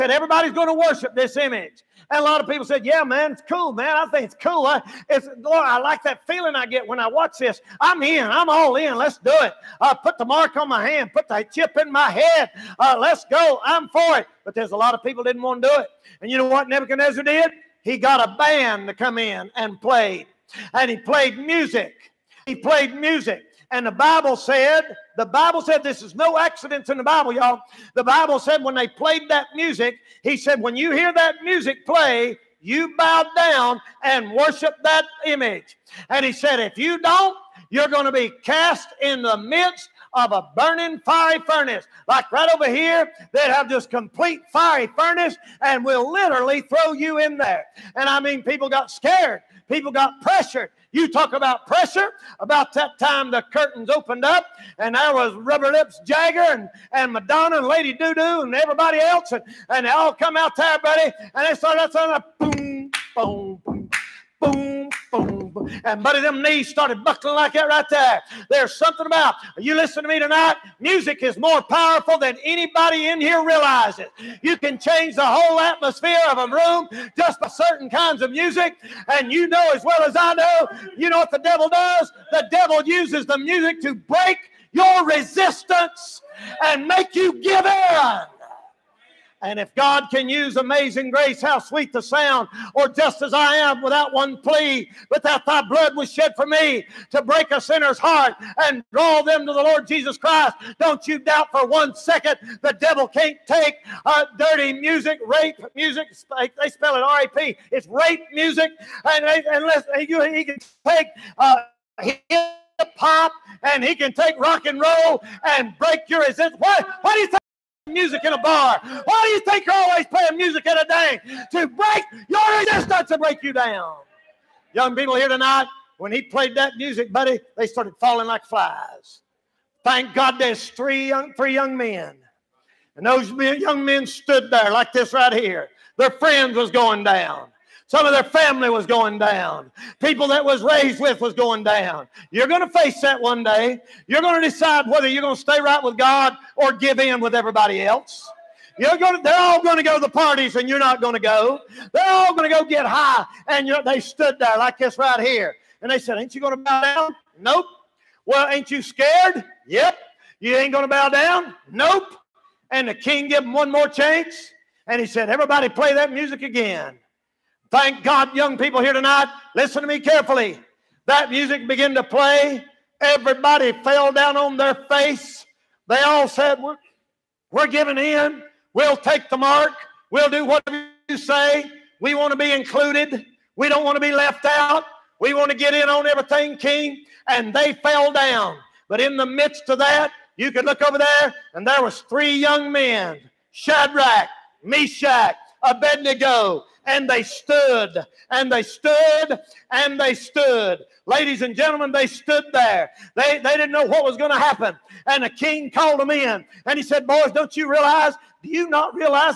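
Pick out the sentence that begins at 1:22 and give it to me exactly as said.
The devil uses the music to break your resistance and make you give in.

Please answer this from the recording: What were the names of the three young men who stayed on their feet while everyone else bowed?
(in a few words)
Shadrach, Meshach, Abednego.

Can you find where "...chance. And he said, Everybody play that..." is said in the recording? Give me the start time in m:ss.
2:43.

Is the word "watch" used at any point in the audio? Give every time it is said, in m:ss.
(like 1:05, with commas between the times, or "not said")
0:07.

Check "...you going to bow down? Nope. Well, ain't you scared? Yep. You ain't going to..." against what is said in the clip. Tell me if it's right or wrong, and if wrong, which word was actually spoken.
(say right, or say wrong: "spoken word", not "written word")
right.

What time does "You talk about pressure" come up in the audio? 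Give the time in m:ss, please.
0:50.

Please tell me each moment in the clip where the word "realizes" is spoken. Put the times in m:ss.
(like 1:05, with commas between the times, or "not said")
1:13, 3:27.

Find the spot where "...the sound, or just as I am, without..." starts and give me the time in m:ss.
1:31.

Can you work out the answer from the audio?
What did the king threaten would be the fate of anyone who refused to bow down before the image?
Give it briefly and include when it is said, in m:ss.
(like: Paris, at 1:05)
burning fiery furnace, at 0:40.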